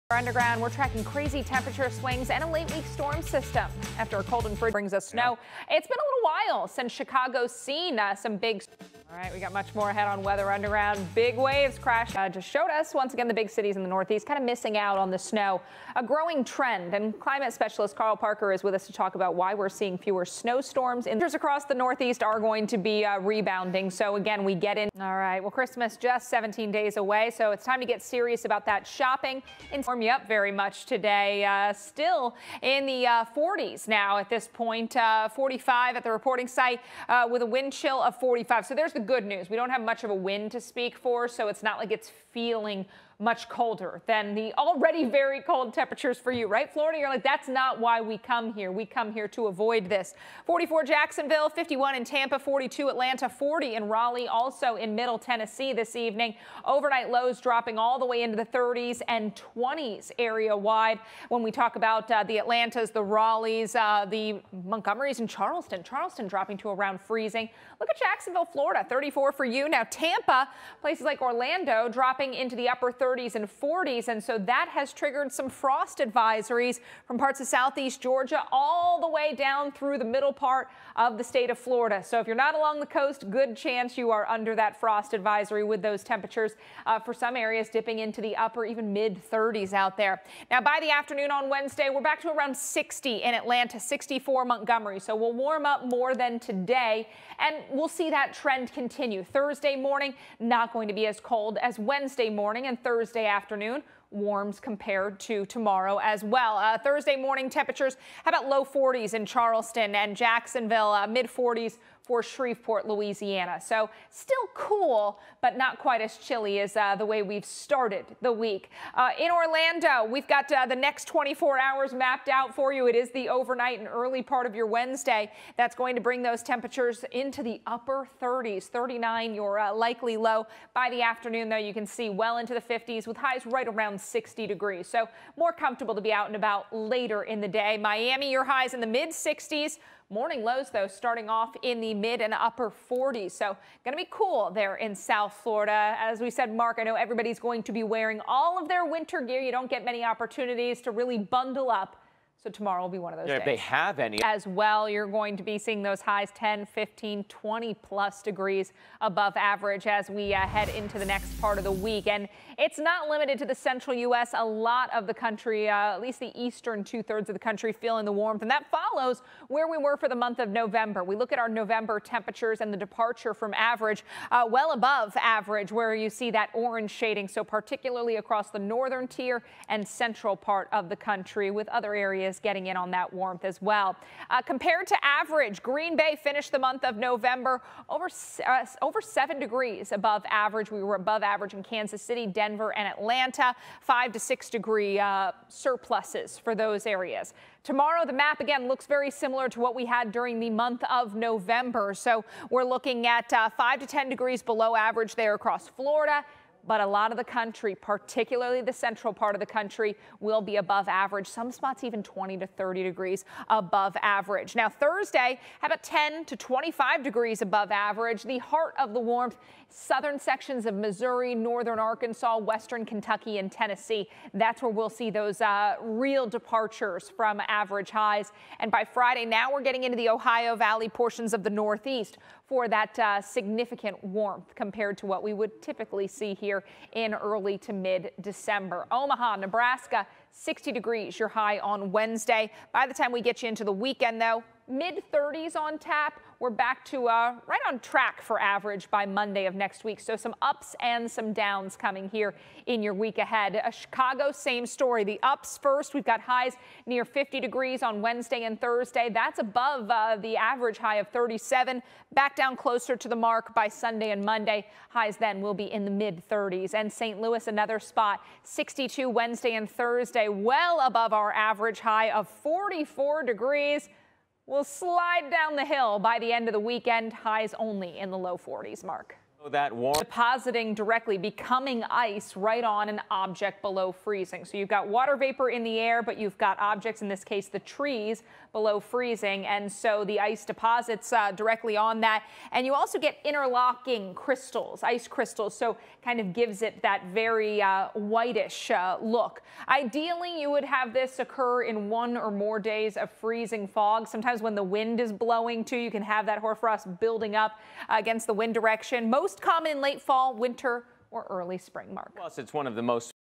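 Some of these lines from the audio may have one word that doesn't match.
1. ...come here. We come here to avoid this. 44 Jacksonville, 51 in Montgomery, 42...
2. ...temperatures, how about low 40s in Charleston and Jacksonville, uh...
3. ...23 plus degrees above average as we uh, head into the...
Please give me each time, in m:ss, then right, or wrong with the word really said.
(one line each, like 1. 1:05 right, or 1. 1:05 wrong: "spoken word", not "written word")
1. 0:48 wrong: "Tampa", not "Montgomery"
2. 1:47 right
3. 2:37 wrong: "20", not "23".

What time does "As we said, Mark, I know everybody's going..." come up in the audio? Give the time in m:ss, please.
2:25.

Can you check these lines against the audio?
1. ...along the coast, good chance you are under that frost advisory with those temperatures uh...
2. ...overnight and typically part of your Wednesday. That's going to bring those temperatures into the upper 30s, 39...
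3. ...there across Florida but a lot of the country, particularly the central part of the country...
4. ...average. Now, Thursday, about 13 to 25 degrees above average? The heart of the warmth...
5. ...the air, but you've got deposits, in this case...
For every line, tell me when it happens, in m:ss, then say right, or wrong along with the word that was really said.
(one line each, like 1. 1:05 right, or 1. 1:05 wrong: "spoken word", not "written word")
1. 1:22 right
2. 2:03 wrong: "early", not "typically"
3. 3:25 right
4. 3:34 wrong: "10", not "13"
5. 4:45 wrong: "objects", not "deposits".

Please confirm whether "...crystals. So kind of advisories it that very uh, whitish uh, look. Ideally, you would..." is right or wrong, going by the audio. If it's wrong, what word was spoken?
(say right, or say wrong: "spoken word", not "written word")
wrong: "gives", not "advisories".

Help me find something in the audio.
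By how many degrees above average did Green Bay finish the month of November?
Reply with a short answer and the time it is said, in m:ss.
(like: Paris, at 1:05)
over 7 degrees, at 3:08.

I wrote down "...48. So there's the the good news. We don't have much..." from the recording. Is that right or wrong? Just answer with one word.
wrong.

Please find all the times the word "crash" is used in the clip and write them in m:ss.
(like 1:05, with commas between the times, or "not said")
0:11.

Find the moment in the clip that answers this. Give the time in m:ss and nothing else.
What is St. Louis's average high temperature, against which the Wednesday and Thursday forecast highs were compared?
4:32.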